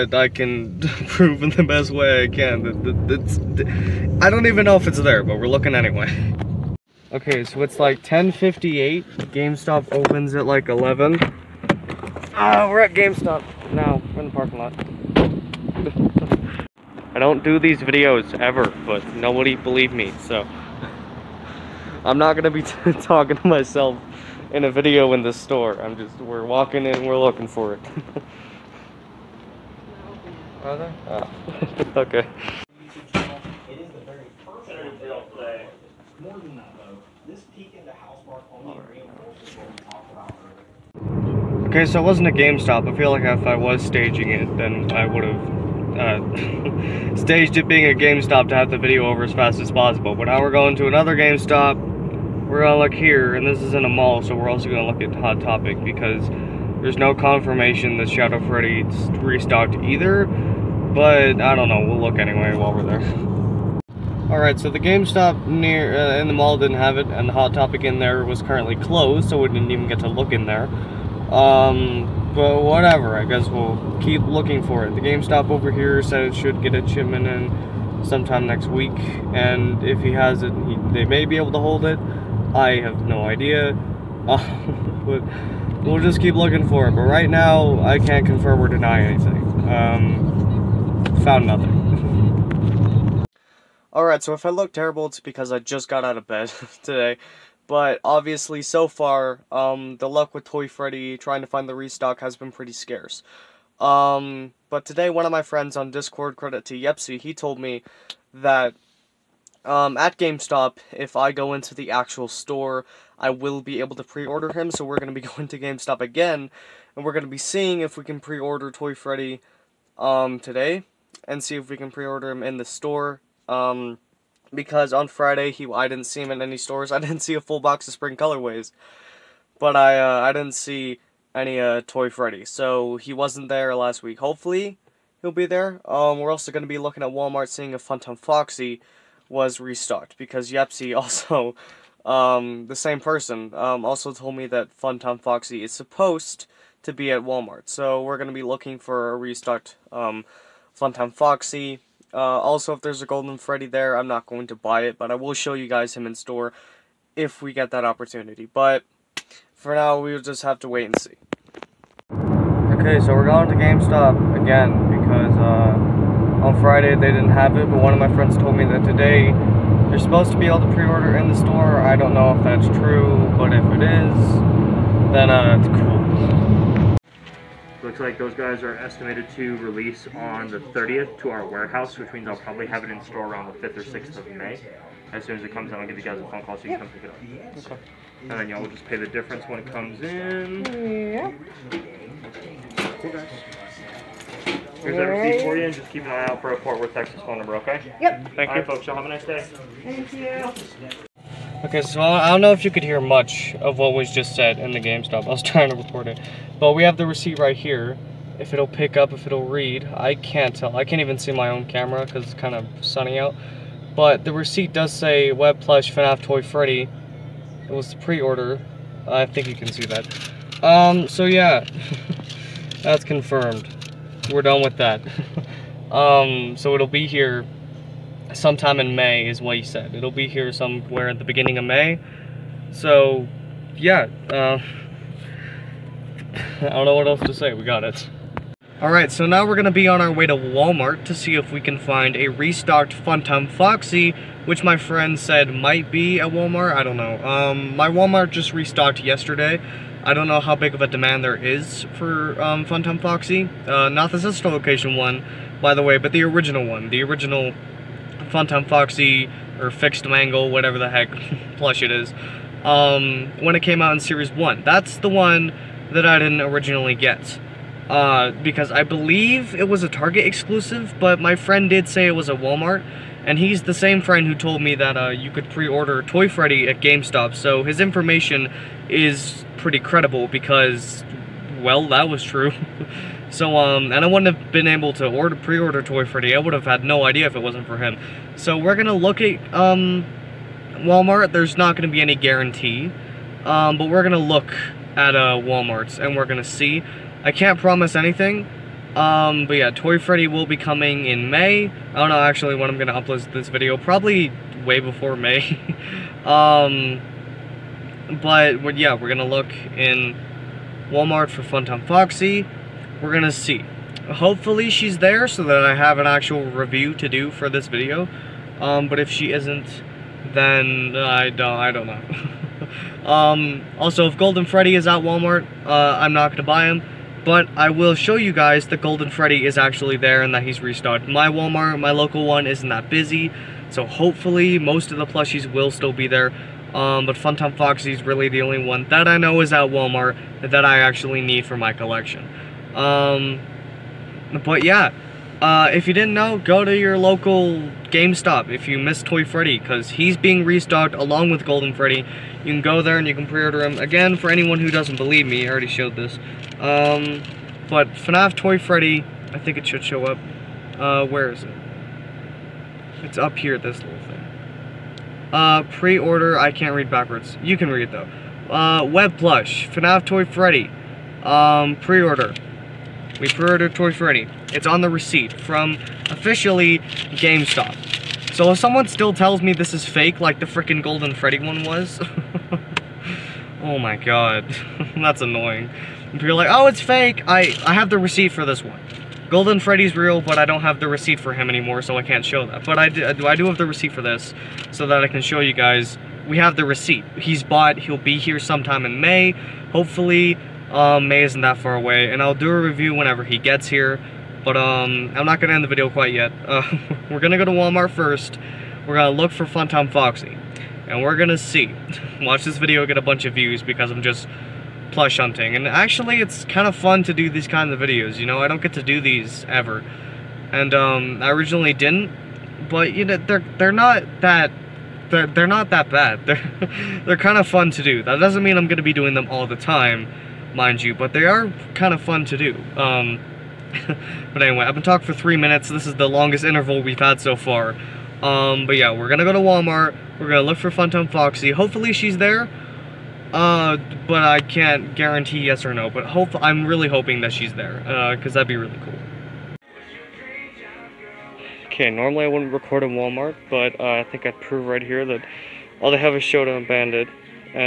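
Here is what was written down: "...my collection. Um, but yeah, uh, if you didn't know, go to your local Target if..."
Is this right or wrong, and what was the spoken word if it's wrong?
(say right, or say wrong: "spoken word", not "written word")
wrong: "GameStop", not "Target".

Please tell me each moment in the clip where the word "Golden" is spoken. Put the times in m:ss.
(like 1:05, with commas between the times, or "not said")
2:33, 5:24, 5:28, 5:51, 6:20, 6:29.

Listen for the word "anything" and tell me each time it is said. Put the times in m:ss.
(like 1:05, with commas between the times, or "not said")
1:28, 4:57.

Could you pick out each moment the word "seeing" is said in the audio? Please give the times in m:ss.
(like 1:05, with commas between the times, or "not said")
1:57, 2:17.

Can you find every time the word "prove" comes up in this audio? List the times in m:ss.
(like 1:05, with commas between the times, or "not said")
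0:01, 7:34.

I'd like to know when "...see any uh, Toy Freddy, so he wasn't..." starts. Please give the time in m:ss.
2:10.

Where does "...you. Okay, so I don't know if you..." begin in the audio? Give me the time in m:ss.
3:20.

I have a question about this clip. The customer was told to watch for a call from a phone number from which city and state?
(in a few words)
Fort Worth, Texas.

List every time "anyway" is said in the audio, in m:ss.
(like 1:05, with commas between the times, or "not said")
0:05, 1:02, 7:14.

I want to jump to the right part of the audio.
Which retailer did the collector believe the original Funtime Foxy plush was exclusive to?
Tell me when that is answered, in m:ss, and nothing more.
4:29.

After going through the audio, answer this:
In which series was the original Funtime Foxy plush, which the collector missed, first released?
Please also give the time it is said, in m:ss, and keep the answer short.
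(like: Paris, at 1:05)
Series 1, at 4:23.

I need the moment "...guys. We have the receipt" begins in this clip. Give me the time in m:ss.
6:35.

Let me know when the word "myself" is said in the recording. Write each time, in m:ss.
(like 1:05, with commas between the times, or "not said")
0:23.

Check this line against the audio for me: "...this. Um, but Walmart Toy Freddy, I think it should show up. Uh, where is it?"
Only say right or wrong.
wrong.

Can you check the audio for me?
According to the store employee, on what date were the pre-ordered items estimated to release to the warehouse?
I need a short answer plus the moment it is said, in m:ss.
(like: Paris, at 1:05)
the 30th, at 3:00.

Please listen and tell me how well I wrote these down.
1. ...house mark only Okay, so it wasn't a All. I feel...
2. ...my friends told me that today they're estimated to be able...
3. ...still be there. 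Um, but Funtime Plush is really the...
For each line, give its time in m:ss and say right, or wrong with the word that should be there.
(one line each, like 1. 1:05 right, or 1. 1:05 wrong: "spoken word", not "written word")
1. 0:37 wrong: "GameStop", not "All"
2. 2:47 wrong: "supposed", not "estimated"
3. 5:35 wrong: "Foxy", not "Plush".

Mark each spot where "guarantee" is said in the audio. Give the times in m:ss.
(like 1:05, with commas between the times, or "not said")
4:52, 7:24.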